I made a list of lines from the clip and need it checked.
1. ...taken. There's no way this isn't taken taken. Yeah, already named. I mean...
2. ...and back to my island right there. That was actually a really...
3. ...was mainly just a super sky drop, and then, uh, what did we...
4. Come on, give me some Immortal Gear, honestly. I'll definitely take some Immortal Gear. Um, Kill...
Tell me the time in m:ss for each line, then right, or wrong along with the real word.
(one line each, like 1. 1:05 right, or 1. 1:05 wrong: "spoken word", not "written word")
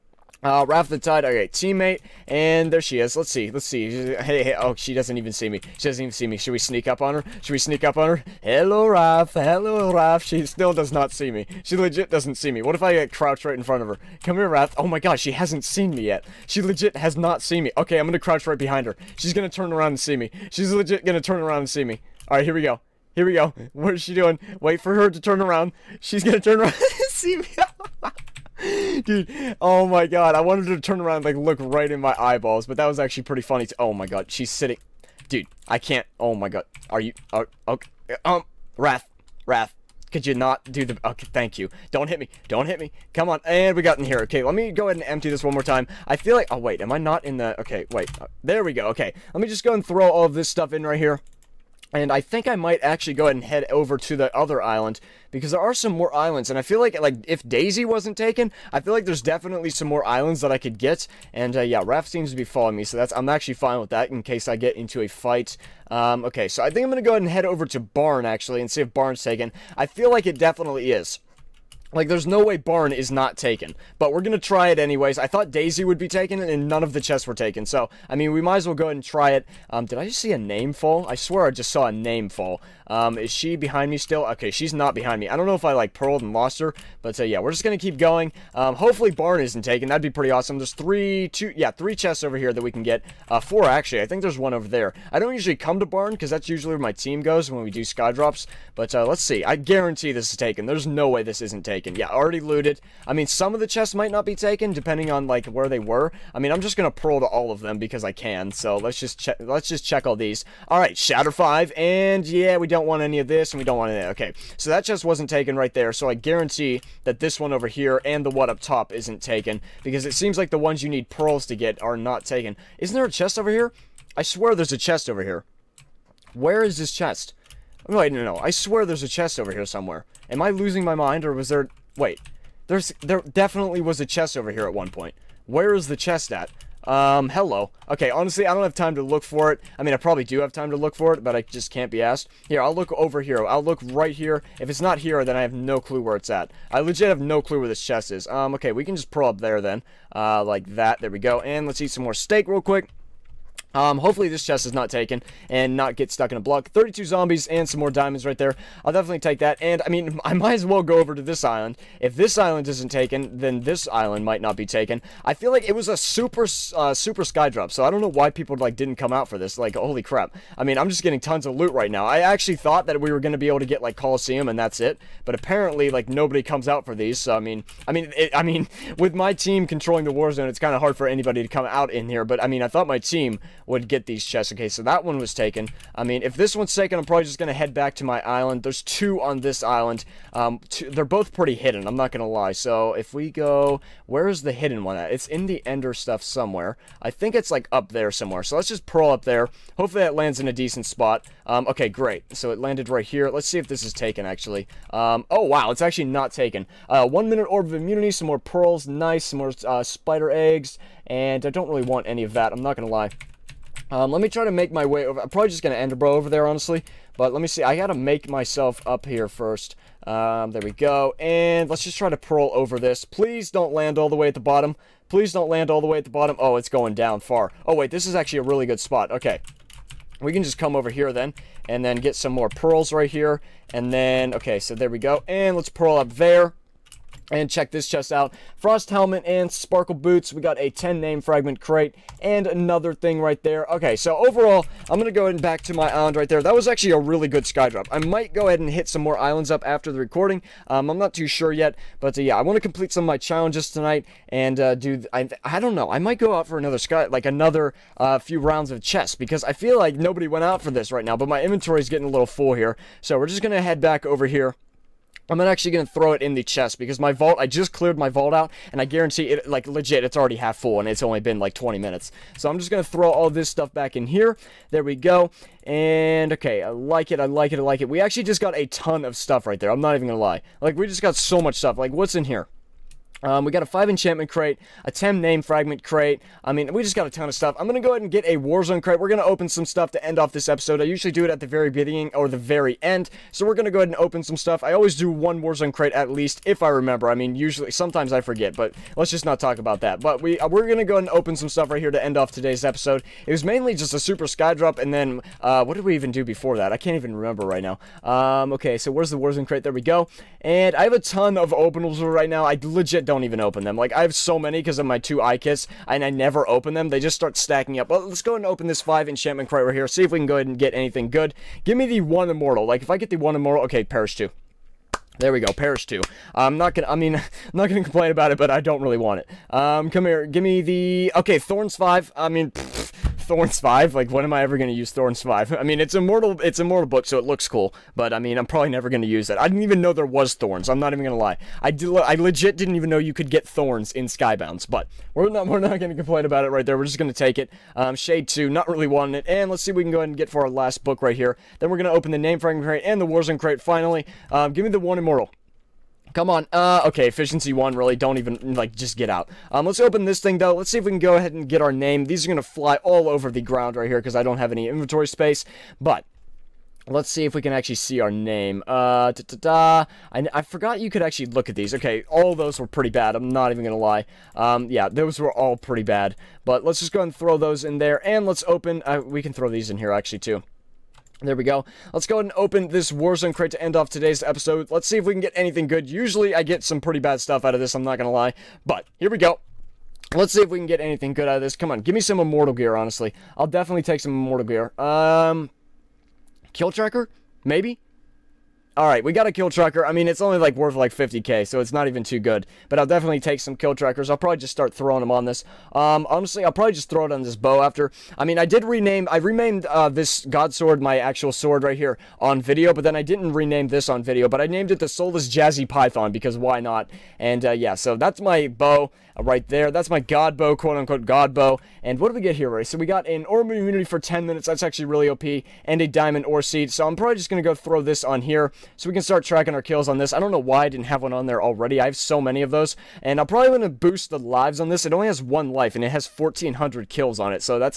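1. 1:40 wrong: "looted", not "named"
2. 4:05 right
3. 5:03 right
4. 6:31 right.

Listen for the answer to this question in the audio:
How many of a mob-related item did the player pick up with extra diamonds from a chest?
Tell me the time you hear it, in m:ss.
2:36.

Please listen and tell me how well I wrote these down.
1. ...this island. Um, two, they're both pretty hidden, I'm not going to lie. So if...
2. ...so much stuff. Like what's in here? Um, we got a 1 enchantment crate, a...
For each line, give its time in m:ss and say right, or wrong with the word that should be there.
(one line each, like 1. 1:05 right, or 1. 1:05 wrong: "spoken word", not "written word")
1. 3:09 right
2. 4:41 wrong: "5", not "1".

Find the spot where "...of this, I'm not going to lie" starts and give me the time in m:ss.
6:27.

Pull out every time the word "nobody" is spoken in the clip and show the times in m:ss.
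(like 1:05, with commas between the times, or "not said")
2:56, 4:19.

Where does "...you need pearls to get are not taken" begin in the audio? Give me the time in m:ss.
2:00.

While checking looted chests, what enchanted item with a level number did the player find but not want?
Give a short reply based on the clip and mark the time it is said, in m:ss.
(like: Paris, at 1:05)
Shatter 5, at 1:50.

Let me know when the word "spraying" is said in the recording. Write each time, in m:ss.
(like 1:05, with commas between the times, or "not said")
not said.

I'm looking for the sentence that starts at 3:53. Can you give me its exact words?
And then, okay, so there we go.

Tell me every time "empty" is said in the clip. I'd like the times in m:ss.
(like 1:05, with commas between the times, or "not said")
0:45.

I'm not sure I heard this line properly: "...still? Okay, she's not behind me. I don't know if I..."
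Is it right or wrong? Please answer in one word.
right.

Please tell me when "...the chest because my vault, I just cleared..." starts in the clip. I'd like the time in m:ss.
4:26.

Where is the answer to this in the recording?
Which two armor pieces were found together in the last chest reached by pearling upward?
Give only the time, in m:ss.
3:58.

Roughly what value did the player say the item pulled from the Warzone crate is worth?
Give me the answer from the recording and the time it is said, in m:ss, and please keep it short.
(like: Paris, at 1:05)
50k, at 6:40.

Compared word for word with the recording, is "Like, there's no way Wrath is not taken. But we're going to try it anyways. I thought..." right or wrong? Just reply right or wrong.
wrong.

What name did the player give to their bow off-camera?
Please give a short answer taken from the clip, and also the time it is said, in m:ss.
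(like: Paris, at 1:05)
Soulless Jazzy Python, at 6:54.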